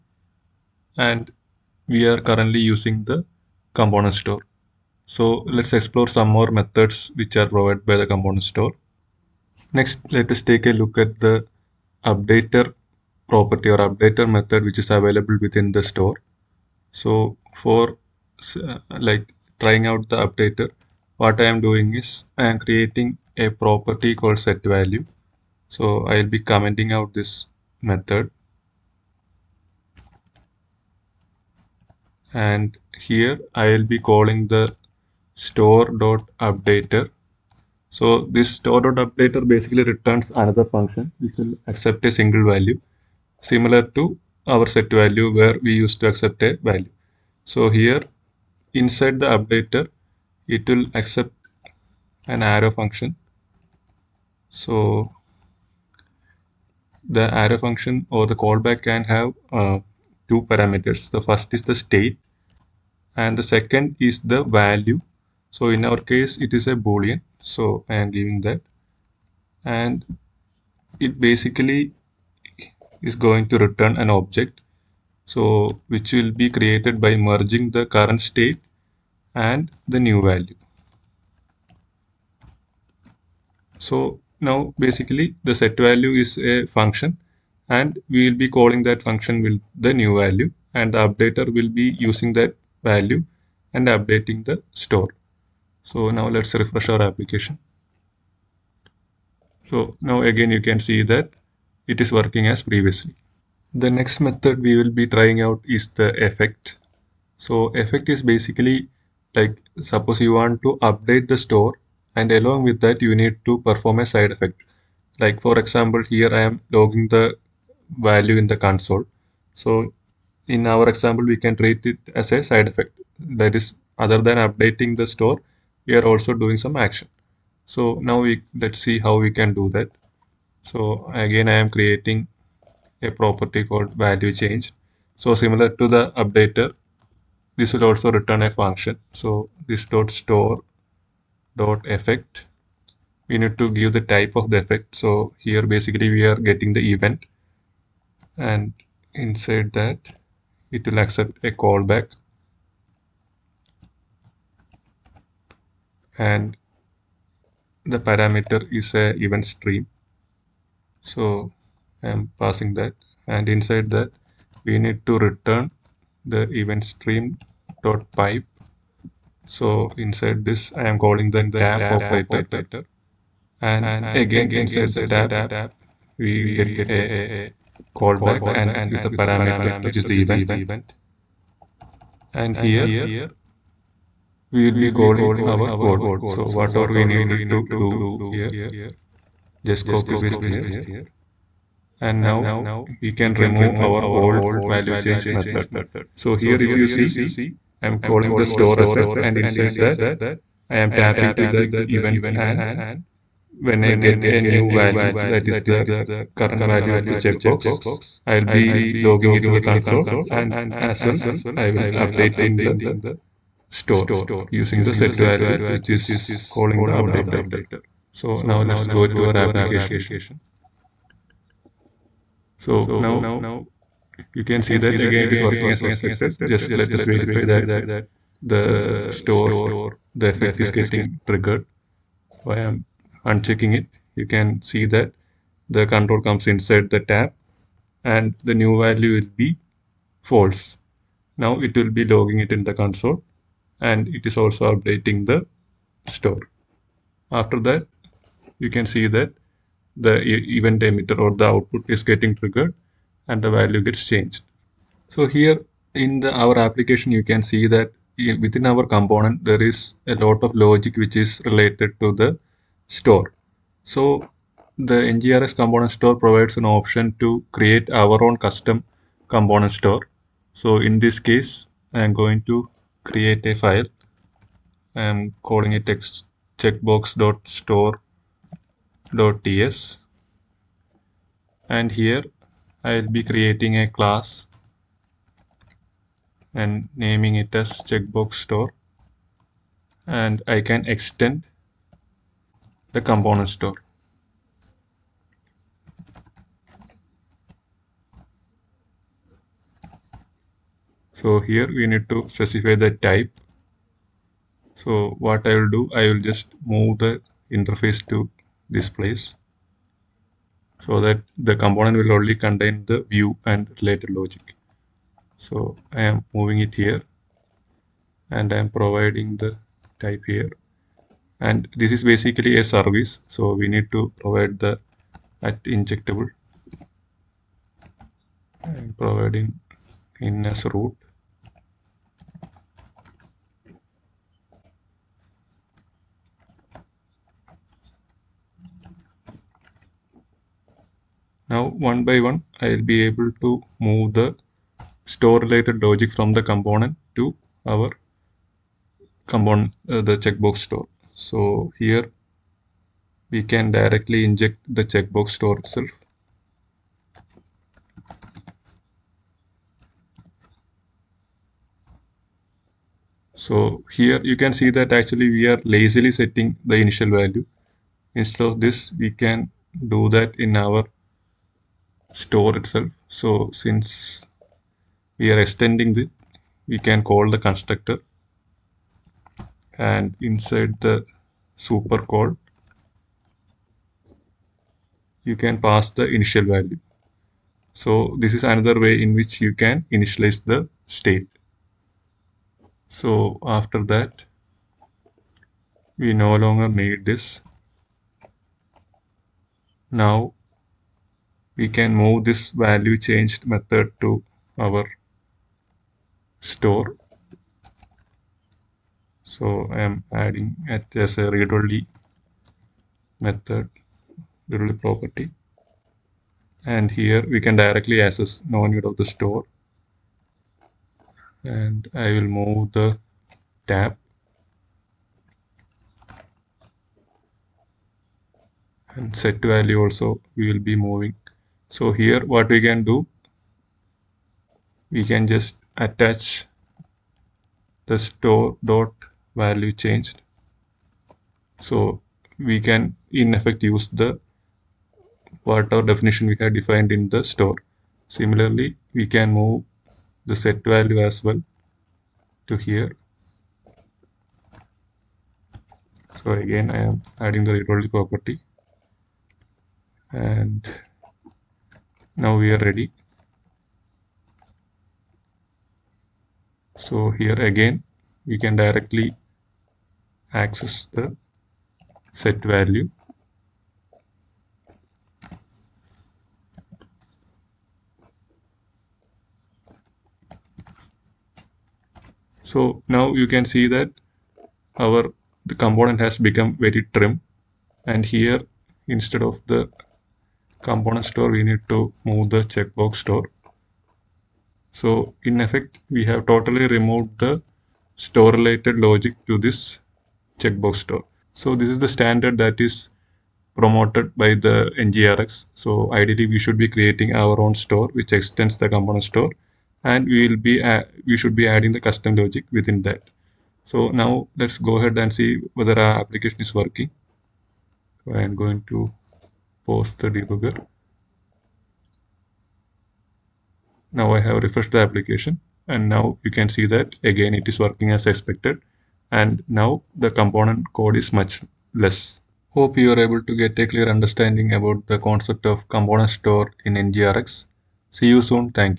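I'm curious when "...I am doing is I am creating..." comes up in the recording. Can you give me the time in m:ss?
0:21.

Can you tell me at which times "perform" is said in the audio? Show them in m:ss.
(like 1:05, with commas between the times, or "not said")
1:53.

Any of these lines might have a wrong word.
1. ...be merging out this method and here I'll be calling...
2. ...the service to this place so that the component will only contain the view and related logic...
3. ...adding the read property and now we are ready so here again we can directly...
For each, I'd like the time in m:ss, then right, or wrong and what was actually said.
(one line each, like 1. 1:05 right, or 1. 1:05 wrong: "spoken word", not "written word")
1. 0:26 wrong: "commenting", not "merging"
2. 5:07 wrong: "interface", not "service"
3. 7:37 right.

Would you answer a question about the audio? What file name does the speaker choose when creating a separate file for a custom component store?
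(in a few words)
checkbox.store.ts.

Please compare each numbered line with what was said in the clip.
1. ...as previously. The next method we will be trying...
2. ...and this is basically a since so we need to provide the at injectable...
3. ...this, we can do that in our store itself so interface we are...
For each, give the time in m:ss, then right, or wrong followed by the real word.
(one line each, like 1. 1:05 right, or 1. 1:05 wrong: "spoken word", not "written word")
1. 1:42 right
2. 5:21 wrong: "service", not "since"
3. 6:08 wrong: "since", not "interface".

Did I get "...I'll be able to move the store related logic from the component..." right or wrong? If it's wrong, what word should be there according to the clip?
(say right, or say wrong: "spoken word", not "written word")
right.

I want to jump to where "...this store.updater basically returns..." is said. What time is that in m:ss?
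0:38.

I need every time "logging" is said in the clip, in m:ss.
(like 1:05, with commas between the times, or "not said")
1:56, 3:28, 4:02.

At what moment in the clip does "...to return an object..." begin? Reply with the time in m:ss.
1:13.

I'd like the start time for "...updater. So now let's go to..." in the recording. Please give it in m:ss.
3:36.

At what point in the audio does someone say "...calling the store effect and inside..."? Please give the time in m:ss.
3:17.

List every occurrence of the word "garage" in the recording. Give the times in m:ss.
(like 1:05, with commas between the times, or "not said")
not said.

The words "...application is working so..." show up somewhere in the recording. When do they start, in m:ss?
8:35.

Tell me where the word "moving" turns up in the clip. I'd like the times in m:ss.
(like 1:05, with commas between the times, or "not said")
5:16, 7:10.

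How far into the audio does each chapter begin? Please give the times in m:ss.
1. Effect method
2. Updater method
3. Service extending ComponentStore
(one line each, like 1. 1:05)
1. 1:42
2. 0:08
3. 4:14.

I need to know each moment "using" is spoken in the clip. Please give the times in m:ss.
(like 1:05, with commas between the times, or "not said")
0:02, 1:32, 3:34.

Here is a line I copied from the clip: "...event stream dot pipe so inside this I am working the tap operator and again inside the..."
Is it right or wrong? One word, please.
wrong.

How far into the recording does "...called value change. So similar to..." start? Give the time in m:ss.
2:13.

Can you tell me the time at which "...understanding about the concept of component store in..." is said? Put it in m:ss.
8:53.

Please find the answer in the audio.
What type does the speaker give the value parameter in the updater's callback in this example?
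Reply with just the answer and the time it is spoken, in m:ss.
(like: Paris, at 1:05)
boolean, at 1:06.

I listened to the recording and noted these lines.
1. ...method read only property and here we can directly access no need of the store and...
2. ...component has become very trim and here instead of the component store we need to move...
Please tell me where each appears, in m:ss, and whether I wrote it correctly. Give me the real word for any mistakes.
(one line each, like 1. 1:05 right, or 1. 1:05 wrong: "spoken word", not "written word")
1. 6:53 right
2. 8:05 right.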